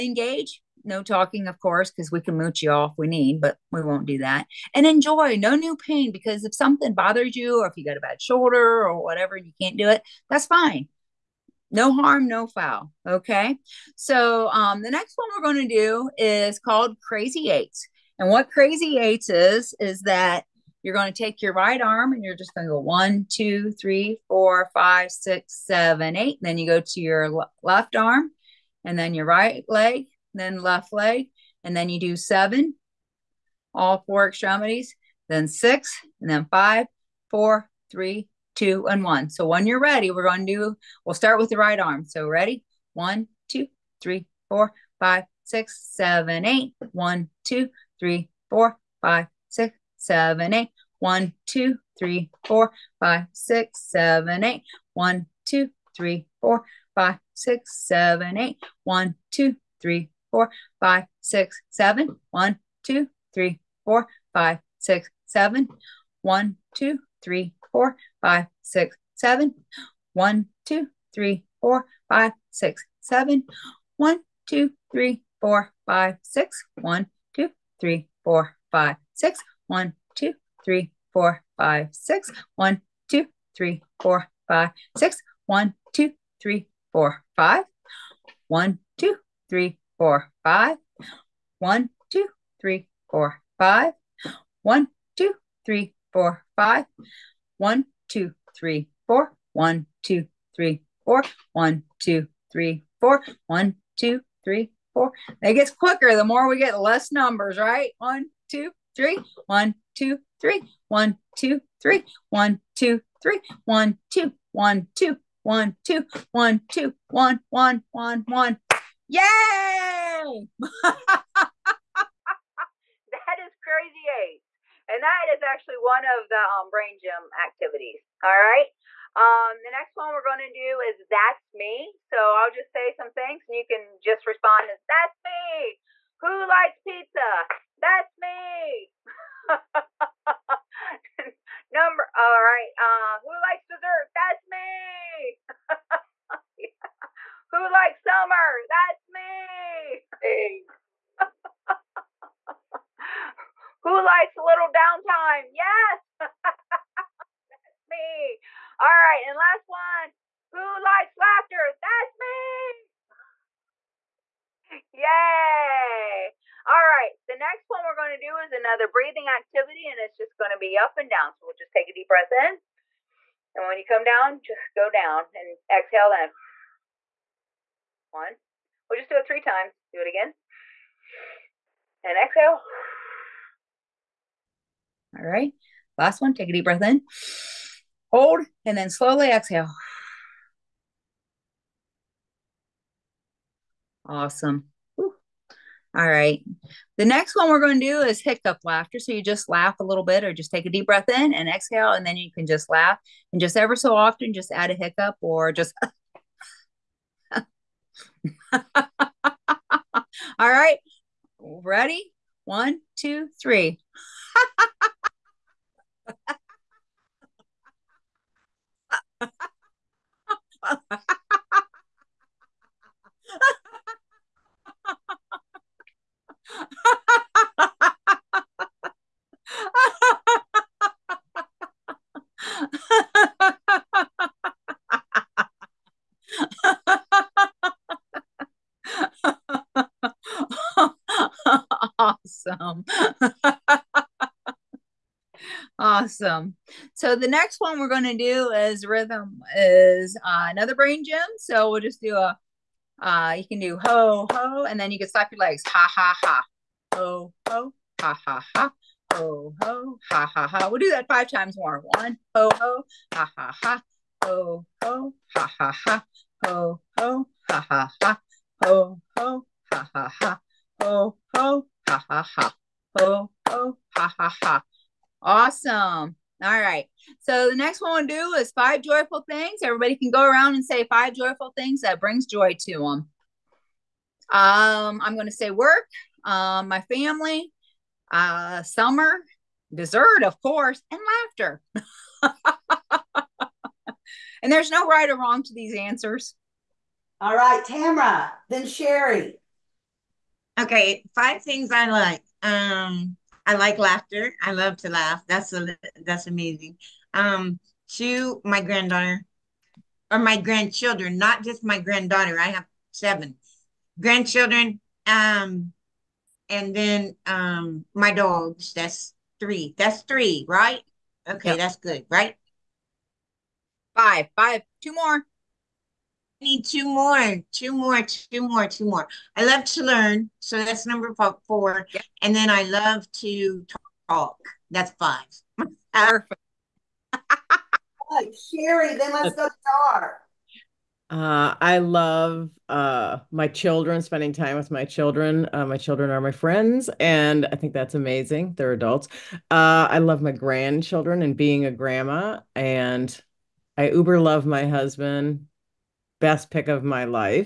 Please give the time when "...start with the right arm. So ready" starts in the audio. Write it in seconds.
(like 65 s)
41 s.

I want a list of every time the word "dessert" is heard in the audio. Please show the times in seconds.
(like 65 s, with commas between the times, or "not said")
143 s, 289 s.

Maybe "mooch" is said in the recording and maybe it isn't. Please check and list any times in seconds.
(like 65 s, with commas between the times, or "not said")
2 s.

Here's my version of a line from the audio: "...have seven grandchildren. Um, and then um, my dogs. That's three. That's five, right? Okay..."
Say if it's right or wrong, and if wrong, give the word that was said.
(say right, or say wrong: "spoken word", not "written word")
wrong: "three", not "five".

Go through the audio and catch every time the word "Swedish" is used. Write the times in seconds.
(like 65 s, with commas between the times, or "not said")
not said.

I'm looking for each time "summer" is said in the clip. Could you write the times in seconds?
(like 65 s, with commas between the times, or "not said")
148 s, 288 s.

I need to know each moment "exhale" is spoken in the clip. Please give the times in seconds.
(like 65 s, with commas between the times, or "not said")
175 s, 182 s, 189 s, 201 s.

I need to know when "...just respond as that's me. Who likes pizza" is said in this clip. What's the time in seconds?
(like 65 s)
133 s.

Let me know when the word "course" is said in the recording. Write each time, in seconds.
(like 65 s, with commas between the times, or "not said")
1 s, 290 s.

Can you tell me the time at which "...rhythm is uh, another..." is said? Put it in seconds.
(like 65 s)
248 s.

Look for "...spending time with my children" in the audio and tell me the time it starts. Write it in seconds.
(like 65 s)
344 s.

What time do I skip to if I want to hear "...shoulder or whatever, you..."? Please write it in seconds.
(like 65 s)
8 s.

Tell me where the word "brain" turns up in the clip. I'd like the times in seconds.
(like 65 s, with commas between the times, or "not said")
126 s, 250 s.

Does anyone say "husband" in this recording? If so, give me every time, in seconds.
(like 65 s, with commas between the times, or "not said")
354 s.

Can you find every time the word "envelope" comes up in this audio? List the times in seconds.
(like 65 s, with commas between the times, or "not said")
not said.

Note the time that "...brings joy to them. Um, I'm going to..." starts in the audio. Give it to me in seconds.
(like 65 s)
281 s.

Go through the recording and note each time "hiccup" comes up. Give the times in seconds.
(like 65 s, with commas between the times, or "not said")
198 s, 204 s.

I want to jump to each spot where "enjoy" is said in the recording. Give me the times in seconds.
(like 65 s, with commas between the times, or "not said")
4 s.